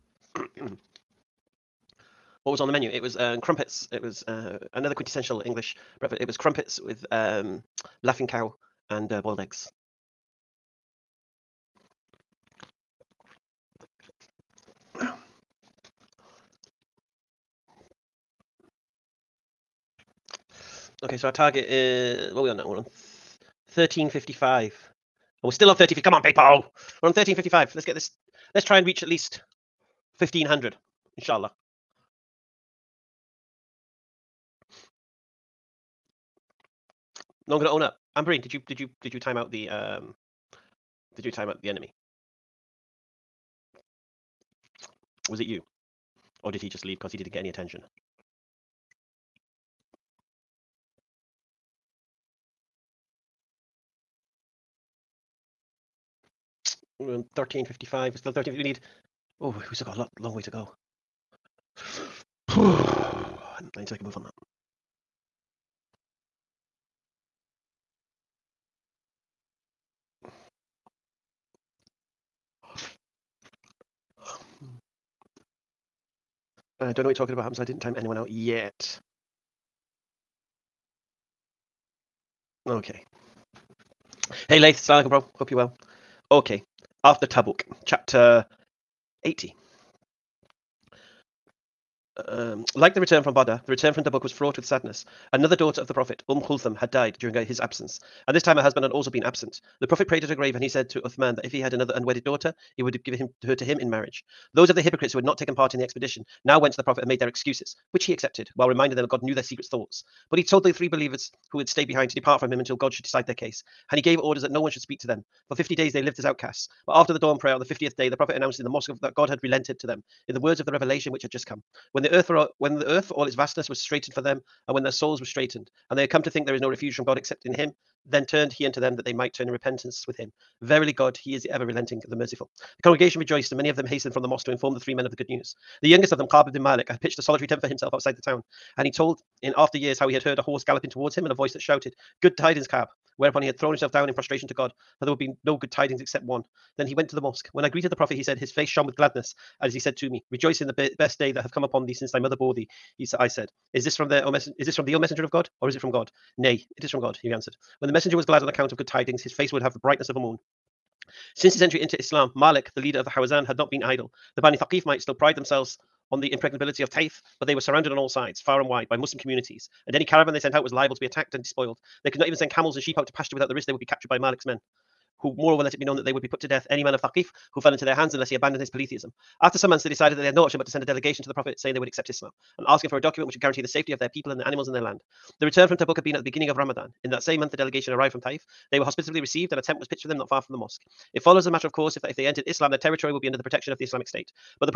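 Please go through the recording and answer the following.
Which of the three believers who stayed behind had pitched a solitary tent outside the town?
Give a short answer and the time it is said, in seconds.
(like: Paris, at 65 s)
Ka'b ibn Malik, at 136 s.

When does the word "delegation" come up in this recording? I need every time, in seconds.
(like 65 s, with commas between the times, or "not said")
180 s, 187 s.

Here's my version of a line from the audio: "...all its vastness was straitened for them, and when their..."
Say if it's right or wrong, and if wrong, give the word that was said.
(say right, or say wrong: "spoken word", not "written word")
right.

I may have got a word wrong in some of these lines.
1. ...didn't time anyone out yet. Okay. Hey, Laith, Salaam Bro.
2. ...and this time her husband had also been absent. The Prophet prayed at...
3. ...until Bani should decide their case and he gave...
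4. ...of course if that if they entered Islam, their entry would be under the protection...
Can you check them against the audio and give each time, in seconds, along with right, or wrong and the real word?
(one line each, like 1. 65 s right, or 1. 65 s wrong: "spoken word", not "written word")
1. 77 s right
2. 98 s right
3. 112 s wrong: "God", not "Bani"
4. 191 s wrong: "territory", not "entry".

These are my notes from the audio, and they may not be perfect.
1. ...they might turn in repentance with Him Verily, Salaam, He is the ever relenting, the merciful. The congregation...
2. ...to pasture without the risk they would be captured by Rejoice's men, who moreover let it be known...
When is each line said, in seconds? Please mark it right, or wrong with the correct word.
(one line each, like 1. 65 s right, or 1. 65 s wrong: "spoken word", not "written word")
1. 129 s wrong: "God", not "Salaam"
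2. 173 s wrong: "Malik", not "Rejoice".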